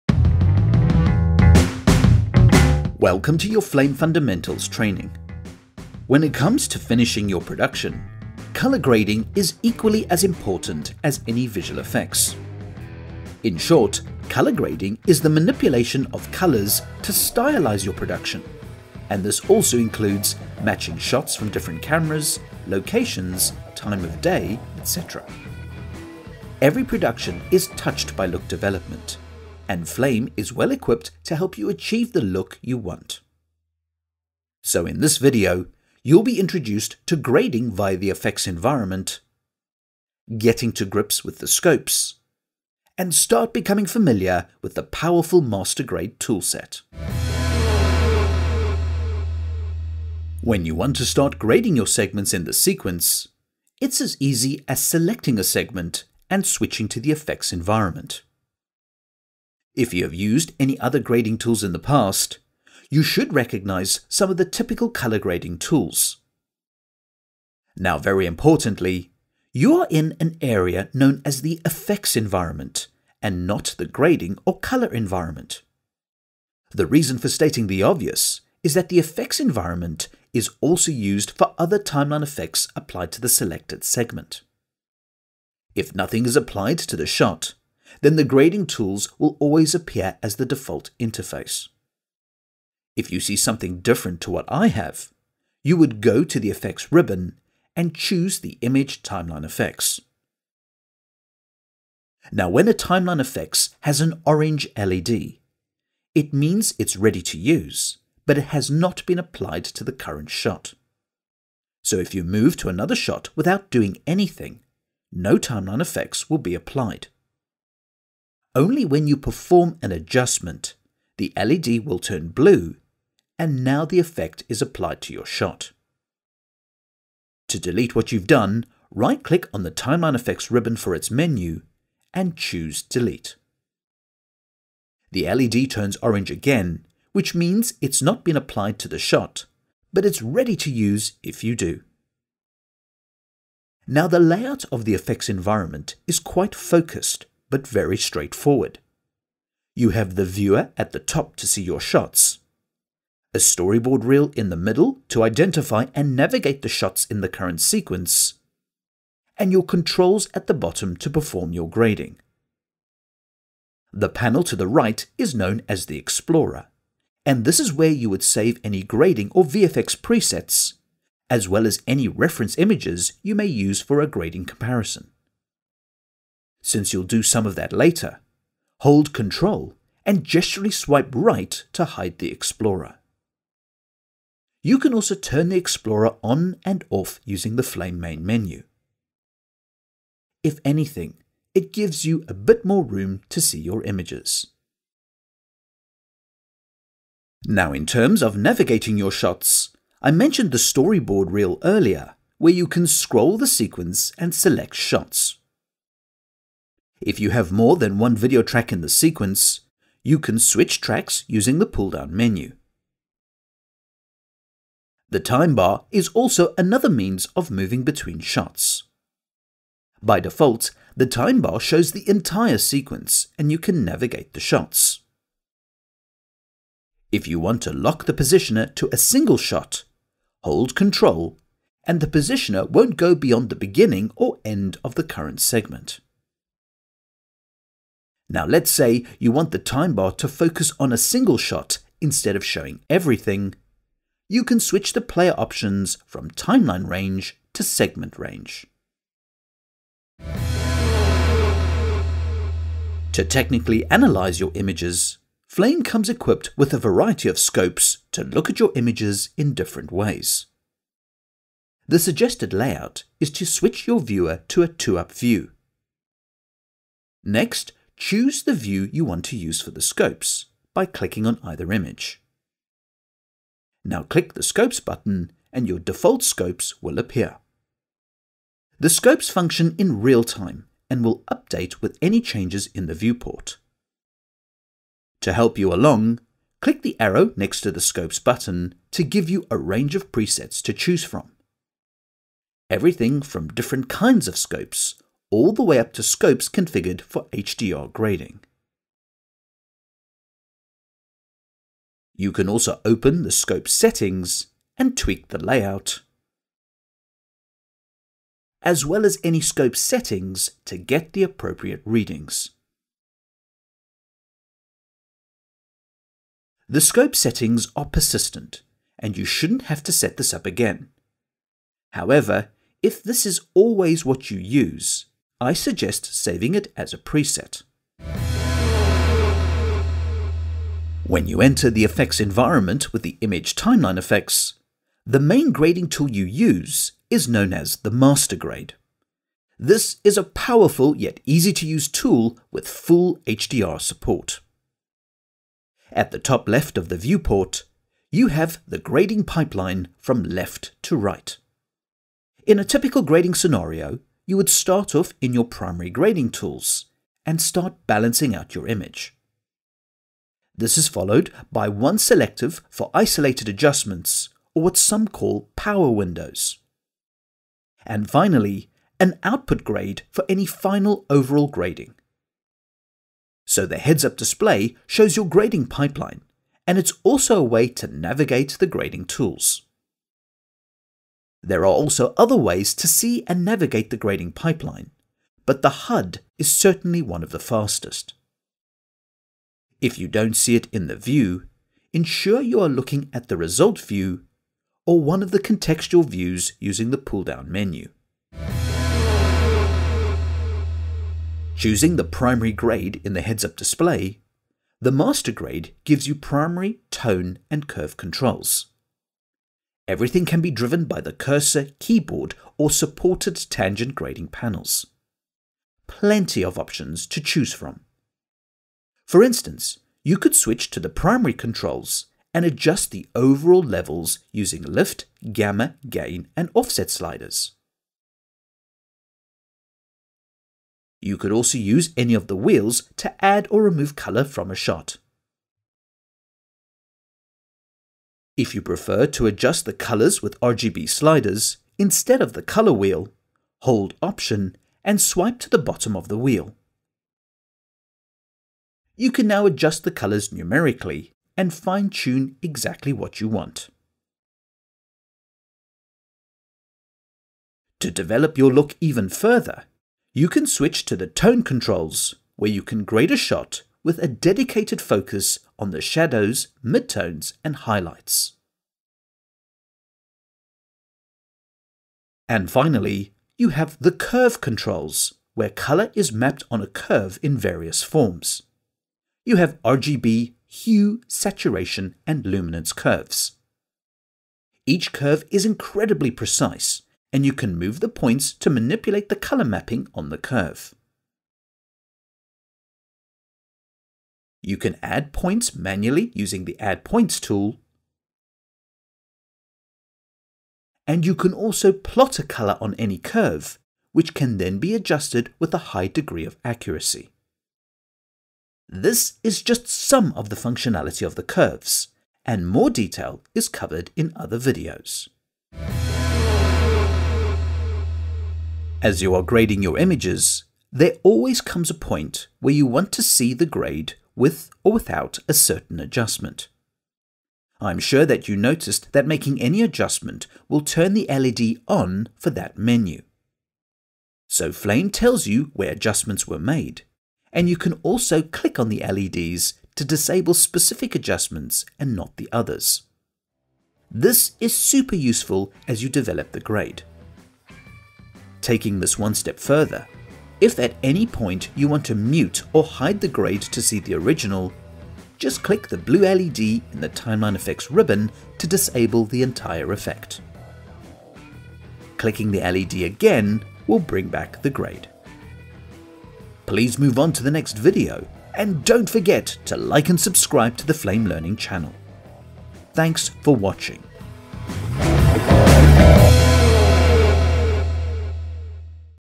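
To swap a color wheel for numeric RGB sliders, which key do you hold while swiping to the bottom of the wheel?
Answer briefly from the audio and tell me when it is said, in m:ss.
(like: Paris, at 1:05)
Option, at 7:24.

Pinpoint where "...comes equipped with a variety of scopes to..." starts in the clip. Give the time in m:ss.
4:15.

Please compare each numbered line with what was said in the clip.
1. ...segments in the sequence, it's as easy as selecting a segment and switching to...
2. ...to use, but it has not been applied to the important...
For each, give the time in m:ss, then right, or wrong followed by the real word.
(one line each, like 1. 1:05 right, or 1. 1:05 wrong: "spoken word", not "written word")
1. 0:51 right
2. 1:47 wrong: "current", not "important".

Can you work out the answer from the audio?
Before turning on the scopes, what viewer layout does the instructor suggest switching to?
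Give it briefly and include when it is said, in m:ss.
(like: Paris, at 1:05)
2-up view, at 4:24.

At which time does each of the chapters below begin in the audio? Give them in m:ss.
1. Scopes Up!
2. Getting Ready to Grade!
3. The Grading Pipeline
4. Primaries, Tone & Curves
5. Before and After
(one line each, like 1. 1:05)
1. 4:11
2. 0:48
3. 5:29
4. 6:39
5. 8:36.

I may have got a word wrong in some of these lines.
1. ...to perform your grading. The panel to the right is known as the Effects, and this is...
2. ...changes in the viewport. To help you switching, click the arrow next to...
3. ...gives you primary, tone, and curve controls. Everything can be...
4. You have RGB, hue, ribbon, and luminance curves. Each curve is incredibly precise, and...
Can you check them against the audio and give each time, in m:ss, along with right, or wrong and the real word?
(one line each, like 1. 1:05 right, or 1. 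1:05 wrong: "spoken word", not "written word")
1. 2:40 wrong: "Explorer", not "Effects"
2. 4:42 wrong: "along", not "switching"
3. 6:45 right
4. 7:59 wrong: "saturation", not "ribbon".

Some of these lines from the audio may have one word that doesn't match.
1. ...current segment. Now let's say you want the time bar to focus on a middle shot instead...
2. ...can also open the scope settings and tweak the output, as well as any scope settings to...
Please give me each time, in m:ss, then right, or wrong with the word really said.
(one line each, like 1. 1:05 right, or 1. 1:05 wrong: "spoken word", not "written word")
1. 3:55 wrong: "single", not "middle"
2. 5:02 wrong: "layout", not "output".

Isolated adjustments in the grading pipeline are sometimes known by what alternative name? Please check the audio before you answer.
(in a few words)
Power windows.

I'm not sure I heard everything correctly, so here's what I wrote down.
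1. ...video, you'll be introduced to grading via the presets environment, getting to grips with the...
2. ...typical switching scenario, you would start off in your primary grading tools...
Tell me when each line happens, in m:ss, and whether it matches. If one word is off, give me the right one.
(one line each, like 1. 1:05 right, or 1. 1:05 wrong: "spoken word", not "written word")
1. 0:35 wrong: "effects", not "presets"
2. 5:52 wrong: "grading", not "switching".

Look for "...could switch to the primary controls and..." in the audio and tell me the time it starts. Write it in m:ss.
7:00.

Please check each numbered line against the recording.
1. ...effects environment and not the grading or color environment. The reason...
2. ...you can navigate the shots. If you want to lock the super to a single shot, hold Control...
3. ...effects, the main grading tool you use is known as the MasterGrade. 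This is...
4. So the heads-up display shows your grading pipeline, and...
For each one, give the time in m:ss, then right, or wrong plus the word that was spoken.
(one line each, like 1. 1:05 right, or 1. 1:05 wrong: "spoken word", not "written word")
1. 1:11 right
2. 3:43 wrong: "positioner", not "super"
3. 5:33 right
4. 6:13 right.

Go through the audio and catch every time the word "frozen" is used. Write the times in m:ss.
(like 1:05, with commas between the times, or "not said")
not said.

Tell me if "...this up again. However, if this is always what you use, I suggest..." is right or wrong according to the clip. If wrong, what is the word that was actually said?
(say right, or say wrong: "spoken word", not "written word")
right.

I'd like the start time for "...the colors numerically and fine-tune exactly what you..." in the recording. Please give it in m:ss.
7:29.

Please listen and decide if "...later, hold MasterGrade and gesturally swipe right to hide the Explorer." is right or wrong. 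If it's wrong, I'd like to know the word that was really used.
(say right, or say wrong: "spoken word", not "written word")
wrong: "Control", not "MasterGrade".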